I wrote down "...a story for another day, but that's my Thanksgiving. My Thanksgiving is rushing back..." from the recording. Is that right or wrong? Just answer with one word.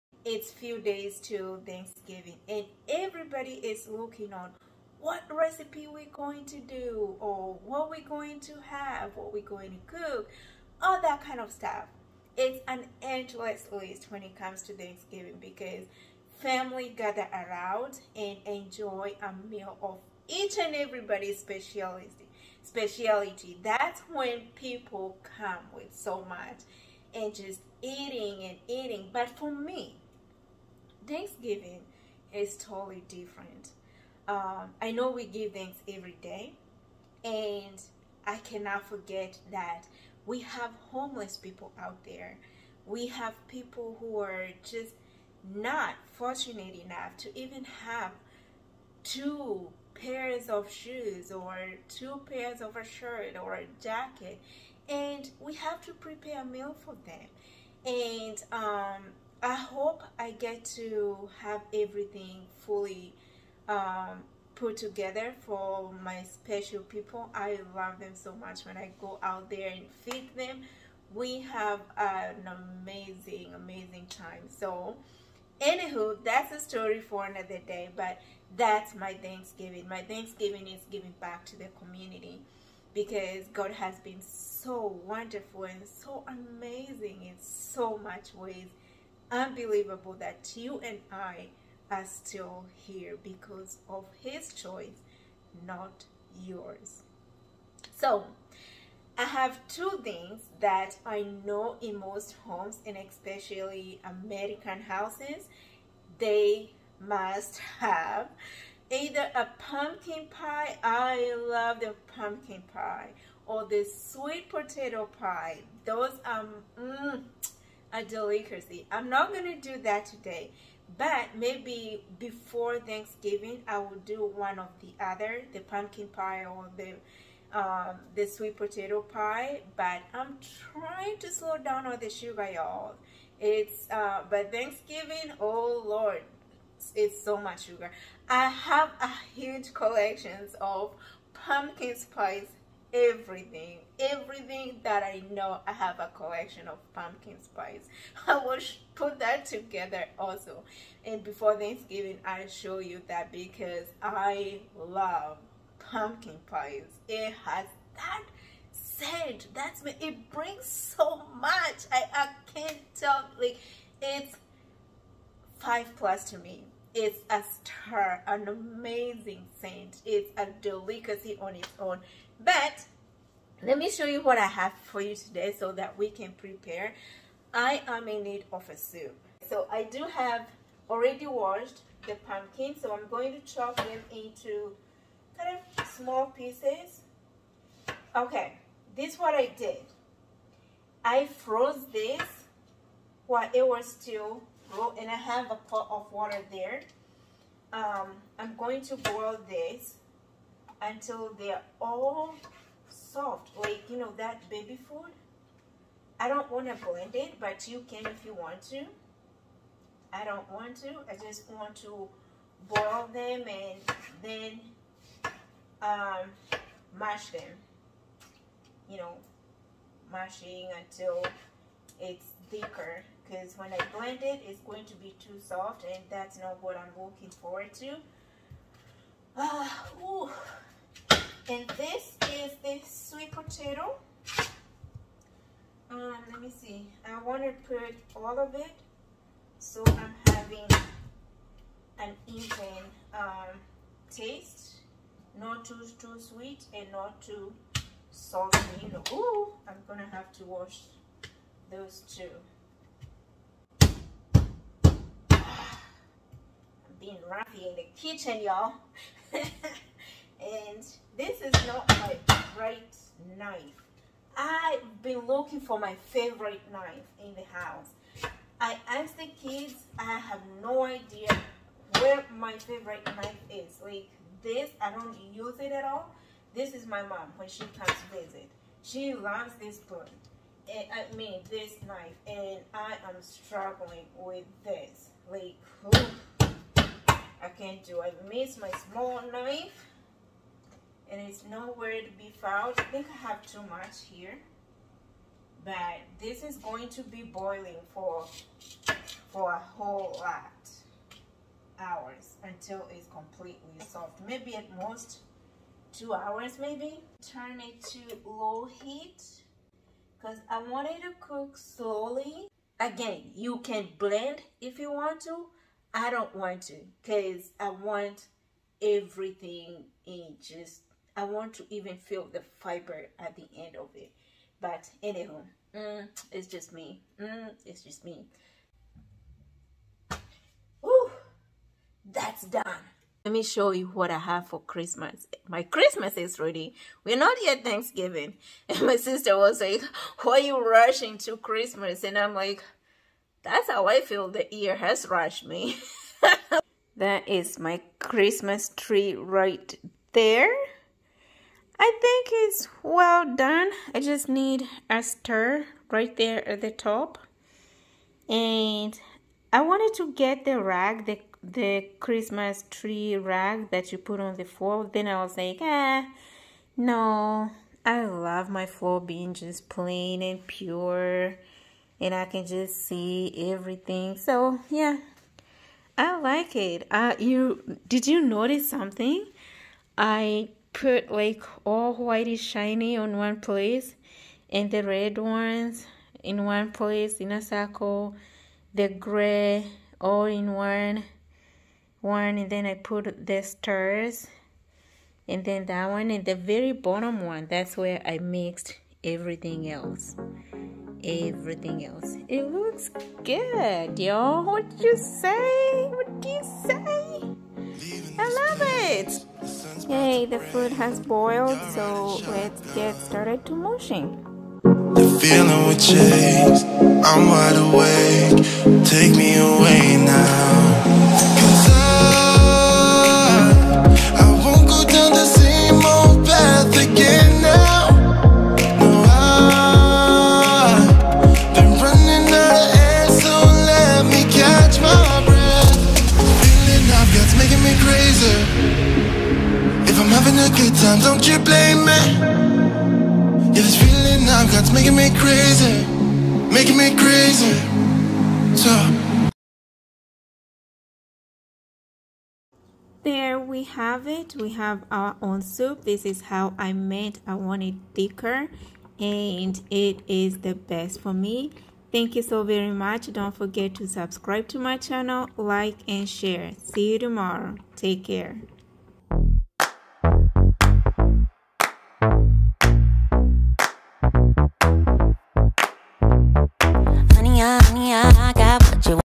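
wrong.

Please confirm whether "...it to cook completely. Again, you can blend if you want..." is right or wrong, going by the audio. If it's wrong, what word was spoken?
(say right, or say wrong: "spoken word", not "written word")
wrong: "slowly", not "completely".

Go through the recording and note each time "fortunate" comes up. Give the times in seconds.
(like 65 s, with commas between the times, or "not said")
46 s.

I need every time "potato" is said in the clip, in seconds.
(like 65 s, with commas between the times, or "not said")
114 s, 128 s, 233 s.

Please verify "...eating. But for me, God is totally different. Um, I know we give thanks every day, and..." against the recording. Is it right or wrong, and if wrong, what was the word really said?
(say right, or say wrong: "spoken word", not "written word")
wrong: "Thanksgiving", not "God".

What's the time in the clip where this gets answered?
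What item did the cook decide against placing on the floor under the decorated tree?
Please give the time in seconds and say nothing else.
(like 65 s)
361 s.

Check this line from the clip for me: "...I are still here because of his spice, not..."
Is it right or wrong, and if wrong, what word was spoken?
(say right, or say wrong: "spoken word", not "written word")
wrong: "choice", not "spice".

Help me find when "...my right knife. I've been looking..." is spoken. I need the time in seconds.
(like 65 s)
261 s.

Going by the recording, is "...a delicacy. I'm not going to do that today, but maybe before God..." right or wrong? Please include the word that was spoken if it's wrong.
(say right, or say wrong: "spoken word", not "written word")
wrong: "Thanksgiving", not "God".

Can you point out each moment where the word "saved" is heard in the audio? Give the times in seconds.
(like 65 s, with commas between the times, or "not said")
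not said.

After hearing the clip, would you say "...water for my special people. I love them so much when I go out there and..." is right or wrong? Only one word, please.
wrong.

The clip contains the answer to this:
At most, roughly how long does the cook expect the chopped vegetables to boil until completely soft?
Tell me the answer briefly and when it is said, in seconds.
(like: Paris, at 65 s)
2 hours, at 305 s.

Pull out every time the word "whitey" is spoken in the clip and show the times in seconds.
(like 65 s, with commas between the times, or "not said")
381 s.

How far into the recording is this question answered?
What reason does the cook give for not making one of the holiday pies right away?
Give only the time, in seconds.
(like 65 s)
131 s.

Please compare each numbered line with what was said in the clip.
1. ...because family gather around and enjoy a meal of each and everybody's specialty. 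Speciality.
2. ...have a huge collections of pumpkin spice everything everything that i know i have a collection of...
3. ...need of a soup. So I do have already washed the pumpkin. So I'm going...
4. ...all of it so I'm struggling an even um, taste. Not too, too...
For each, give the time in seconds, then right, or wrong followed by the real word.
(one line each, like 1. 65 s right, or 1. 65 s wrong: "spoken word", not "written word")
1. 15 s right
2. 138 s right
3. 178 s right
4. 238 s wrong: "having", not "struggling".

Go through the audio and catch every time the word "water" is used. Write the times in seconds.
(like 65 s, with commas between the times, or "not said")
196 s.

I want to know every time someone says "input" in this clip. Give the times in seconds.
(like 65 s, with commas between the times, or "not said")
not said.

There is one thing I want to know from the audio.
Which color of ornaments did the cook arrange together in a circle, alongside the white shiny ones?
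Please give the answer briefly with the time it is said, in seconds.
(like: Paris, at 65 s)
red, at 384 s.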